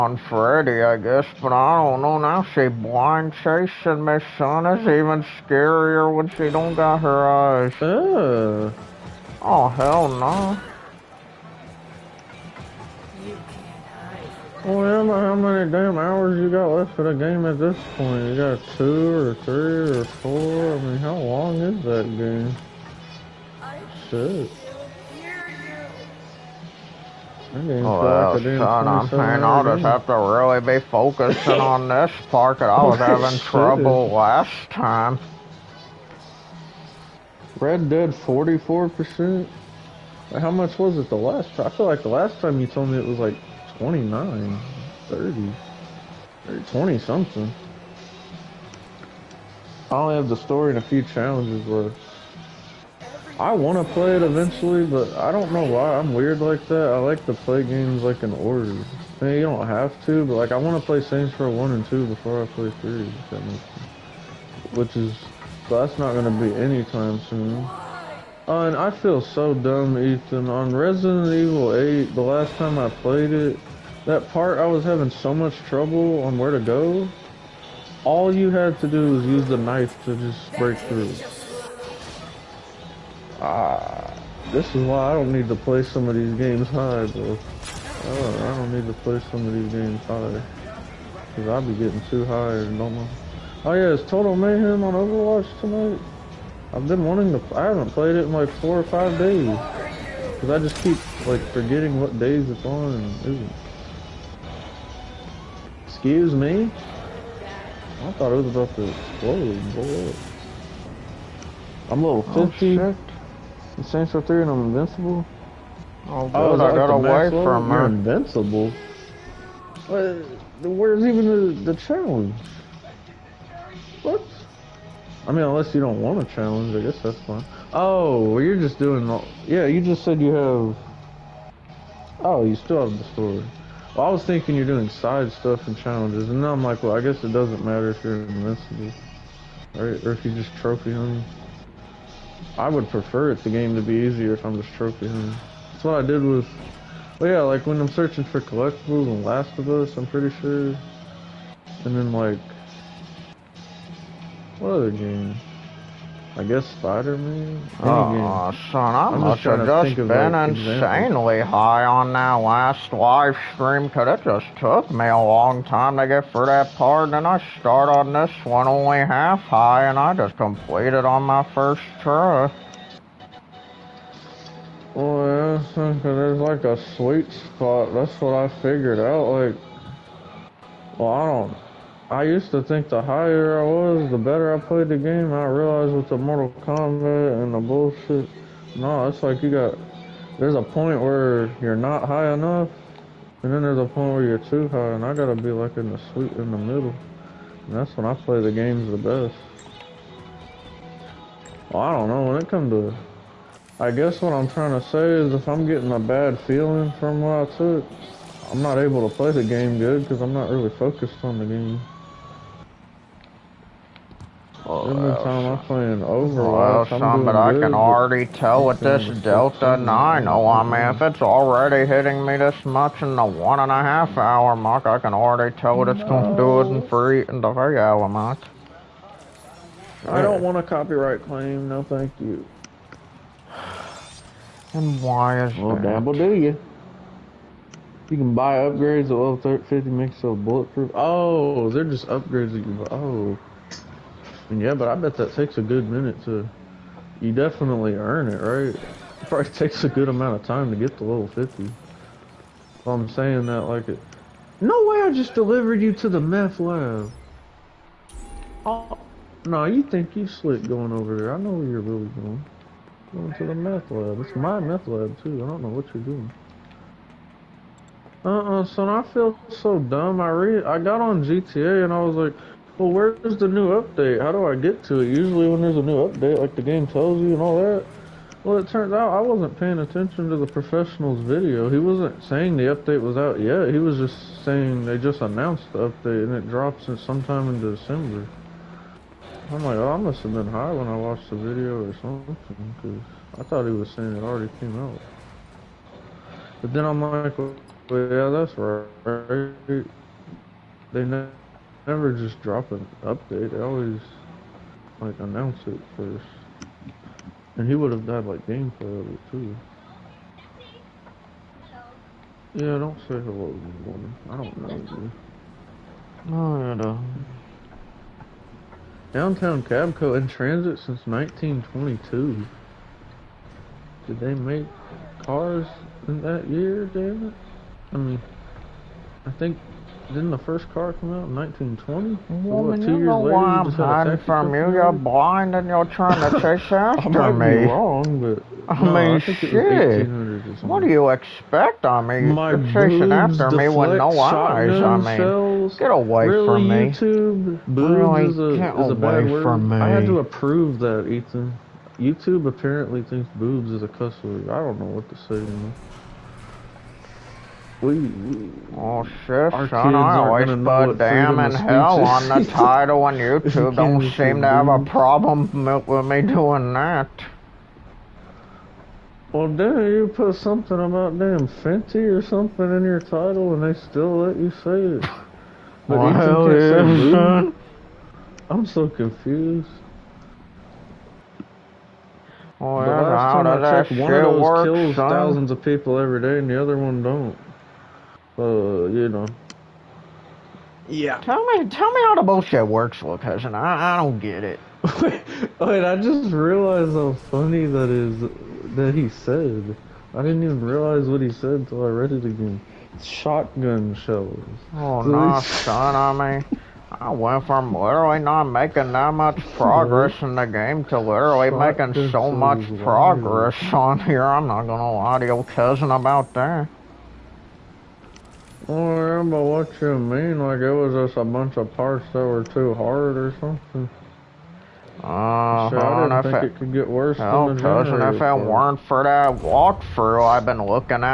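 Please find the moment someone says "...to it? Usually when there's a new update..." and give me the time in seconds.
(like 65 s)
274 s.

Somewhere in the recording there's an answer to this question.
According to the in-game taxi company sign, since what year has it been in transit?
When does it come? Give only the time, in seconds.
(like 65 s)
321 s.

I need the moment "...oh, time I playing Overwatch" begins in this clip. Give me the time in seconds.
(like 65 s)
215 s.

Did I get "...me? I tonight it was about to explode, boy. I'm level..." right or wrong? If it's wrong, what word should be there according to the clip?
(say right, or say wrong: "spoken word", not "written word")
wrong: "thought", not "tonight".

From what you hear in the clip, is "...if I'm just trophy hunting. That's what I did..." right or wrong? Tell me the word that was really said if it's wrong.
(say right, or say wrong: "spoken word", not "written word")
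right.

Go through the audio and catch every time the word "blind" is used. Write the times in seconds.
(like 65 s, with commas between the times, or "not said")
2 s, 334 s.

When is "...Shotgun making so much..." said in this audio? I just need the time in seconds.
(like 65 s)
411 s.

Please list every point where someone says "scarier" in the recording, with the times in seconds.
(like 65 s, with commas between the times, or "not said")
5 s.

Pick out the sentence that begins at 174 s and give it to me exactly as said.
Well, yeah, because there's like a sweet spot.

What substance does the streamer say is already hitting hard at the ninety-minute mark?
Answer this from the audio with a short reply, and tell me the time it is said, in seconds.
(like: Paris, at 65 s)
Delta 9, at 219 s.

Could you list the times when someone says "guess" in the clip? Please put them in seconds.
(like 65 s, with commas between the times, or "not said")
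0 s, 126 s, 137 s, 156 s, 203 s.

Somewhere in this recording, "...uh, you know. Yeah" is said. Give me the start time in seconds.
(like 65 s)
388 s.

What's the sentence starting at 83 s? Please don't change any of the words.
Uh, this is why I don't need to play some of these games high, bro.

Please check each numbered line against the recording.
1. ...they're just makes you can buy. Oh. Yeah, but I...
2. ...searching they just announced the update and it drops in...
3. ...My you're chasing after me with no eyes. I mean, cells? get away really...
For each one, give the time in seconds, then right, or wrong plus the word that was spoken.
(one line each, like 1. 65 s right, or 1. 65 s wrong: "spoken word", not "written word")
1. 241 s wrong: "upgrades", not "makes"
2. 284 s wrong: "saying", not "searching"
3. 342 s right.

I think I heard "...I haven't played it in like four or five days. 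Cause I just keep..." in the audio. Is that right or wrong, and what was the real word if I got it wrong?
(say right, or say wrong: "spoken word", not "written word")
right.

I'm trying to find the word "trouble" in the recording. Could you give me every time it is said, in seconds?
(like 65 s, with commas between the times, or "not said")
33 s, 75 s.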